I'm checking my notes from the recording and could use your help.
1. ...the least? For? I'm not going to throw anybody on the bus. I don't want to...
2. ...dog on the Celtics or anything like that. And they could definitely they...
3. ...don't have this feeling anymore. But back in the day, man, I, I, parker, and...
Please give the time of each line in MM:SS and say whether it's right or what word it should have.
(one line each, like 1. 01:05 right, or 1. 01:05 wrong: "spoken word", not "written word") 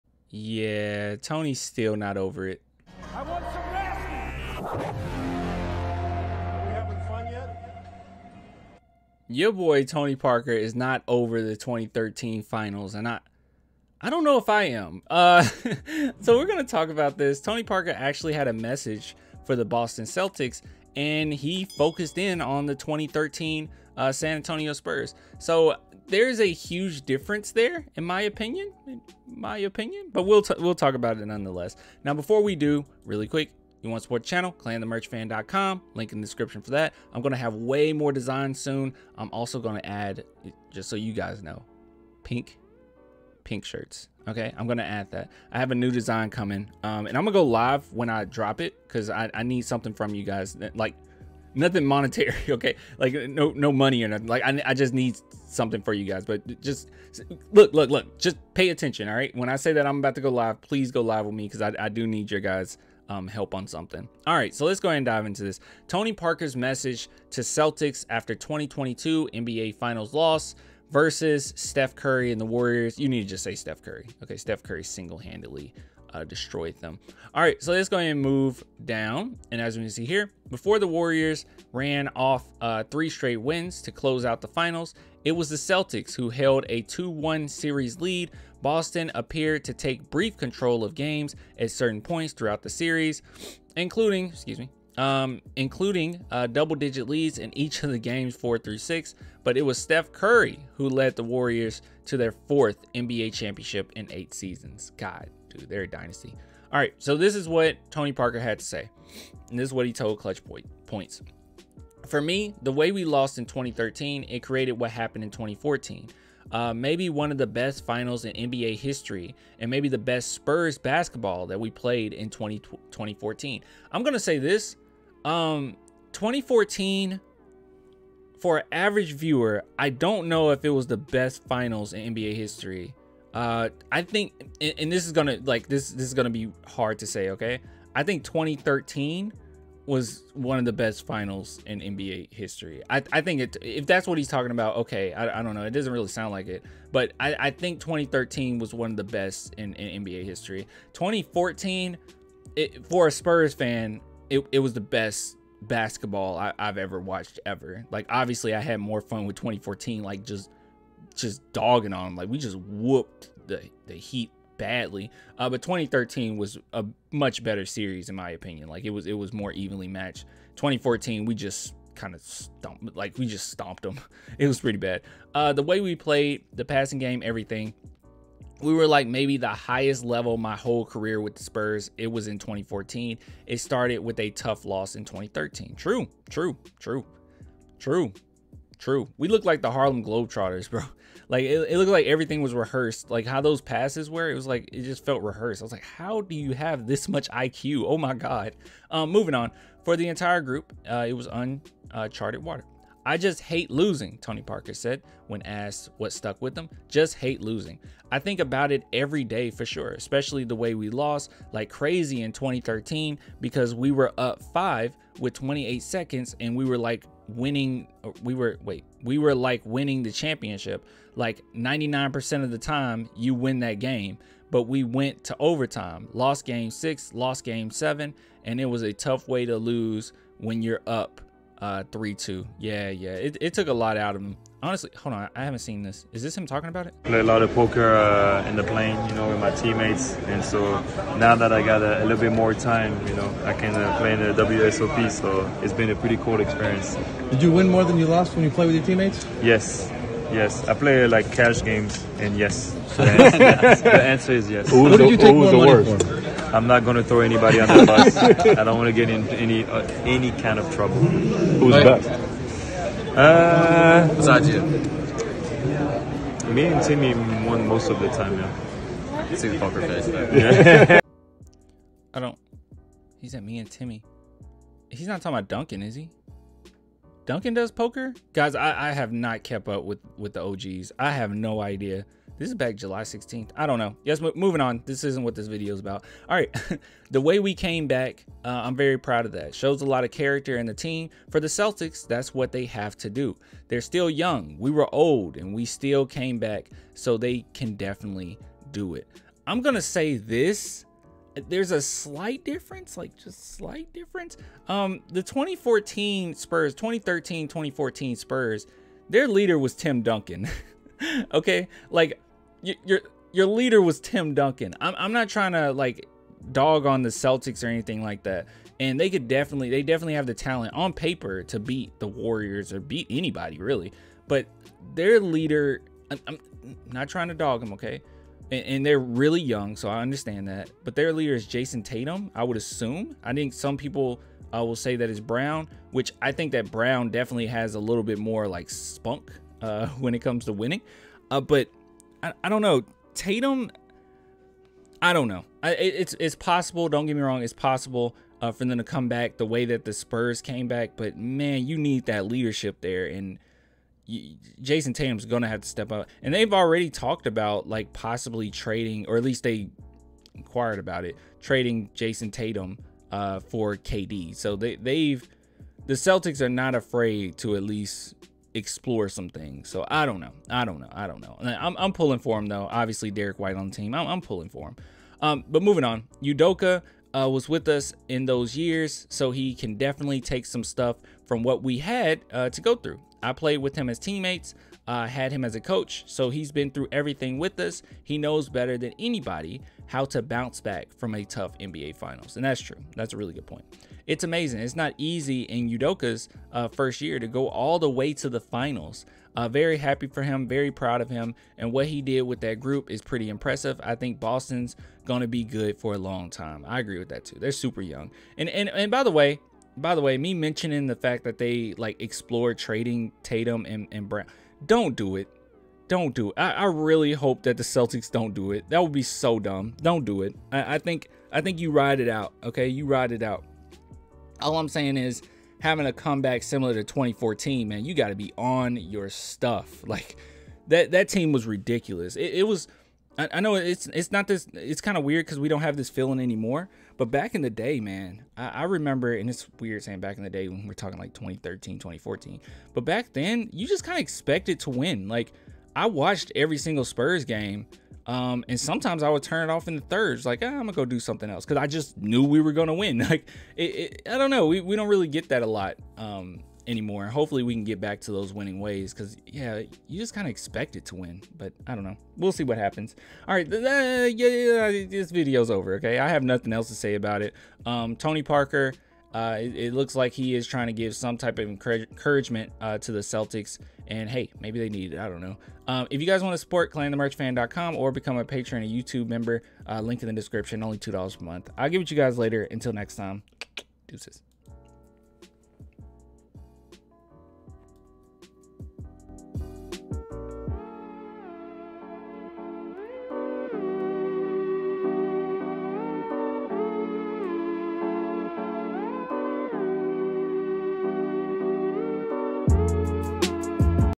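1. 04:15 wrong: "worst", not "least"
2. 05:16 right
3. 07:15 wrong: "remember", not "parker".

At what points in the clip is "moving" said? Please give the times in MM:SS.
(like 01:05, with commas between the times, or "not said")
03:19, 04:44, 06:15.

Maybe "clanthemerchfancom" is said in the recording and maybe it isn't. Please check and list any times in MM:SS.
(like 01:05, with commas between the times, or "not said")
00:34, 07:56.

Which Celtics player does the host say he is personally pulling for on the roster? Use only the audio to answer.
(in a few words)
Derrick White.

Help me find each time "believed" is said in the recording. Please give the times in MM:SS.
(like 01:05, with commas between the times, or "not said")
not said.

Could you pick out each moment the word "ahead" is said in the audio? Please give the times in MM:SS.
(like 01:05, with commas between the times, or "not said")
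01:04, 01:17.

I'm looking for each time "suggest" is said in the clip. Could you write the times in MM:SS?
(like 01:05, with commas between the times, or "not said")
not said.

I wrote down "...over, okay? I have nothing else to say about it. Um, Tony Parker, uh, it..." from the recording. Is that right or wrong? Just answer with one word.
right.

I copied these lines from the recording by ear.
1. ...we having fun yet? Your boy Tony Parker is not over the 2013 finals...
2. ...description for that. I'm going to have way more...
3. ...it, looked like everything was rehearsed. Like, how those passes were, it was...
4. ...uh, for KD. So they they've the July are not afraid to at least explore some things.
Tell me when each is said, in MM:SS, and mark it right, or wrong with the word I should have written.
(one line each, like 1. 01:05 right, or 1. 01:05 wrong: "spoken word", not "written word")
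1. 00:06 right
2. 00:36 right
3. 03:11 right
4. 06:03 wrong: "Celtics", not "July".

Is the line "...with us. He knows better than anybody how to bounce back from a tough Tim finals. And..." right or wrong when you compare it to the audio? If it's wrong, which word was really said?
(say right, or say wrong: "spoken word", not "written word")
wrong: "NBA", not "Tim".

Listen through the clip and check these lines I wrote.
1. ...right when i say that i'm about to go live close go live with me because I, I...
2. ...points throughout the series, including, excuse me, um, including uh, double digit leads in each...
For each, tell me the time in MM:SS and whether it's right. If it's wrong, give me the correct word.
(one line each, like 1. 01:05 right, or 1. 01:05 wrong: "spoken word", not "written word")
1. 00:59 wrong: "please", not "close"
2. 01:32 right.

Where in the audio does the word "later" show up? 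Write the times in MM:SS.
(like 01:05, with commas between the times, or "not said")
08:02.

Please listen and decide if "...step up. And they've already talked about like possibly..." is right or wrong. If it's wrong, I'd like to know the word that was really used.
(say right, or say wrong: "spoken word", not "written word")
right.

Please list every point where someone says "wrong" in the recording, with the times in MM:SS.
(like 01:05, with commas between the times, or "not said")
05:47.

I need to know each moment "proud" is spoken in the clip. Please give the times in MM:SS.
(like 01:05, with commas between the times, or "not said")
04:48, 06:40.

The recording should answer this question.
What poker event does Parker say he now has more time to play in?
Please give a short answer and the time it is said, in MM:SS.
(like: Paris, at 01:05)
WSOP, at 04:04.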